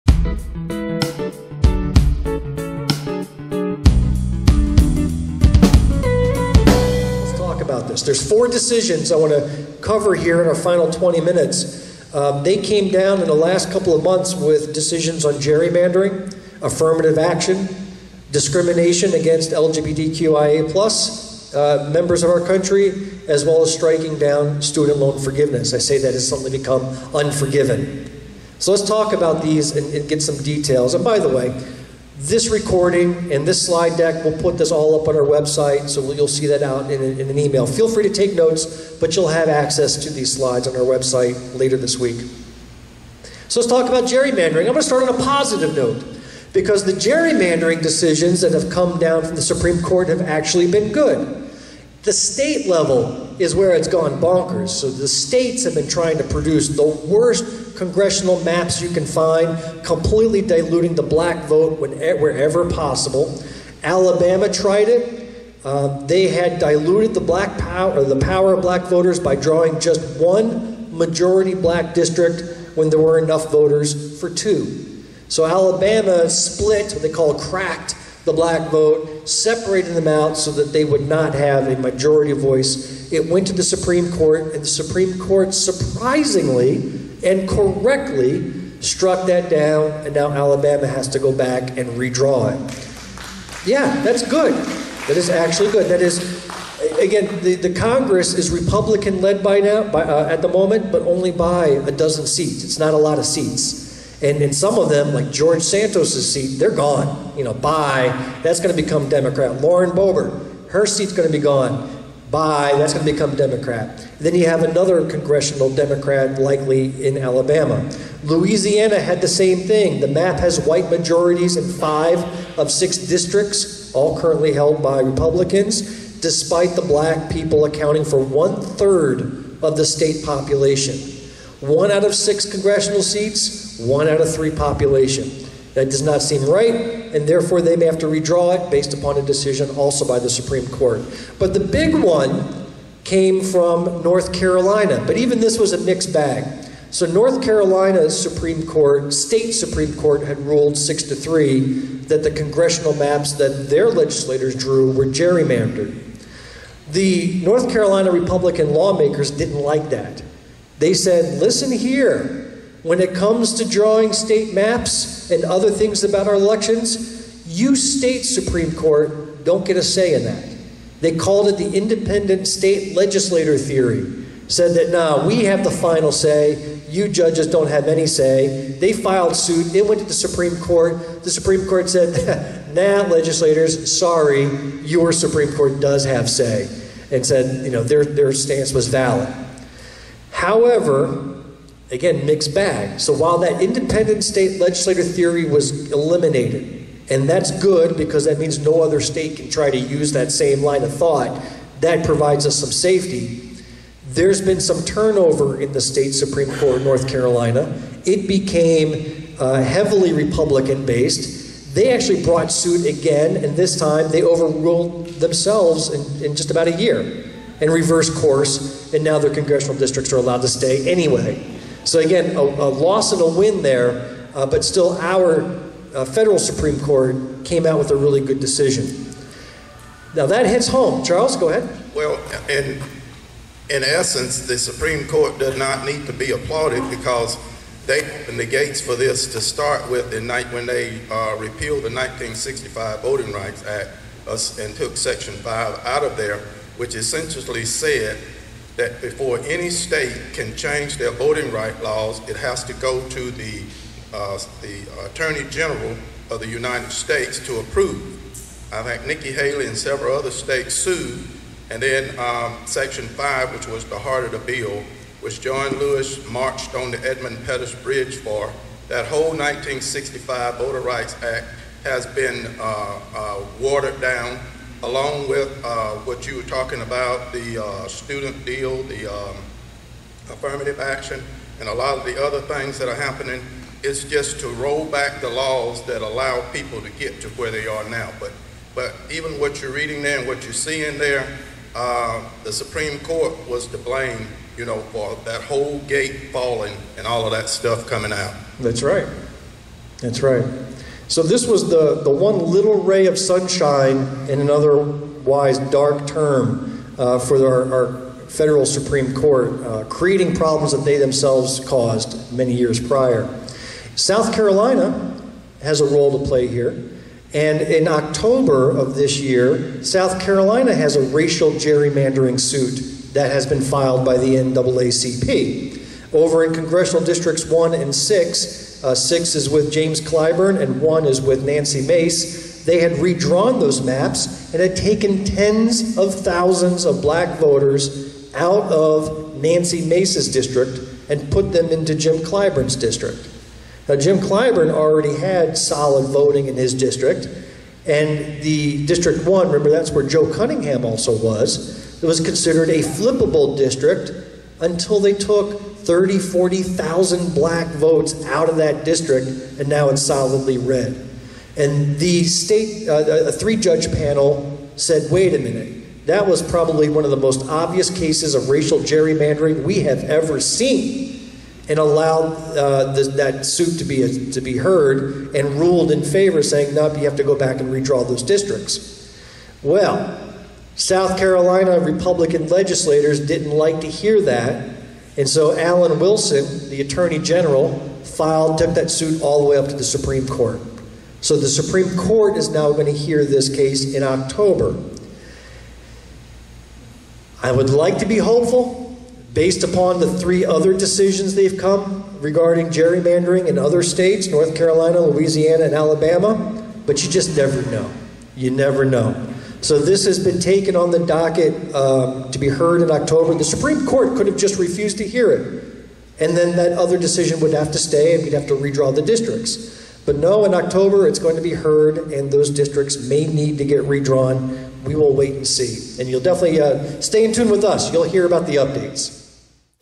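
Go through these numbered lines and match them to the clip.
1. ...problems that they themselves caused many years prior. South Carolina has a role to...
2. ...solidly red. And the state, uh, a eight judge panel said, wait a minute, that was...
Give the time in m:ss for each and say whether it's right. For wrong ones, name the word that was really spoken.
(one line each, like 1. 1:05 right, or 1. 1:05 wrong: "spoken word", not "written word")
1. 5:10 right
2. 6:00 wrong: "three", not "eight".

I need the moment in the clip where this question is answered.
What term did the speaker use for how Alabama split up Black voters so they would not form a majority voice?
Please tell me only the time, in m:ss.
1:17.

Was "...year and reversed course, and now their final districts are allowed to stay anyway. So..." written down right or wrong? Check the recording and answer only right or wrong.
wrong.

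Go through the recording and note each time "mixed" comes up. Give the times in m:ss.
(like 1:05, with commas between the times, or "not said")
2:25, 3:12.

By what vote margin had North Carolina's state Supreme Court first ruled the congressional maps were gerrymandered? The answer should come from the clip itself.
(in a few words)
6 to 3.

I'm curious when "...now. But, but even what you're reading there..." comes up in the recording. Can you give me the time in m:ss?
4:47.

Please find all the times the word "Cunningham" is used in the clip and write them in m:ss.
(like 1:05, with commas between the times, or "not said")
5:50.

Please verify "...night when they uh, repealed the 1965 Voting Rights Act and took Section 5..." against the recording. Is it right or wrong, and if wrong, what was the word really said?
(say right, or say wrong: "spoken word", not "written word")
right.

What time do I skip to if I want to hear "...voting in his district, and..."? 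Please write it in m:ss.
5:46.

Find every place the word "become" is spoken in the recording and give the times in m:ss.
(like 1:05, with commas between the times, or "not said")
0:26, 1:48, 1:53.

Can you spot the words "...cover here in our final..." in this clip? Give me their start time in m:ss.
0:09.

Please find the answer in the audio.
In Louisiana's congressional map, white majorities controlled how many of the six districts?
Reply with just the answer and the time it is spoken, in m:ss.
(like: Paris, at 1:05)
5, at 2:01.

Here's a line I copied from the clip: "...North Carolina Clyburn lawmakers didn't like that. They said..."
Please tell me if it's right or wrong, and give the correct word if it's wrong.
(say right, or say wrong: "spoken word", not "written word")
wrong: "Republican", not "Clyburn".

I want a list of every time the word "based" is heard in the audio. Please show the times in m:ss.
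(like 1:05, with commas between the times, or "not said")
2:18, 3:30, 6:39.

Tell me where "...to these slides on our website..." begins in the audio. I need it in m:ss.
0:40.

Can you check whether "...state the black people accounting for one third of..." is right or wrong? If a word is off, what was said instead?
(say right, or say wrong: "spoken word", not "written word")
wrong: "despite", not "state".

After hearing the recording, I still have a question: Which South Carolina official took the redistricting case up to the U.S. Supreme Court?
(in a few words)
Alan Wilson.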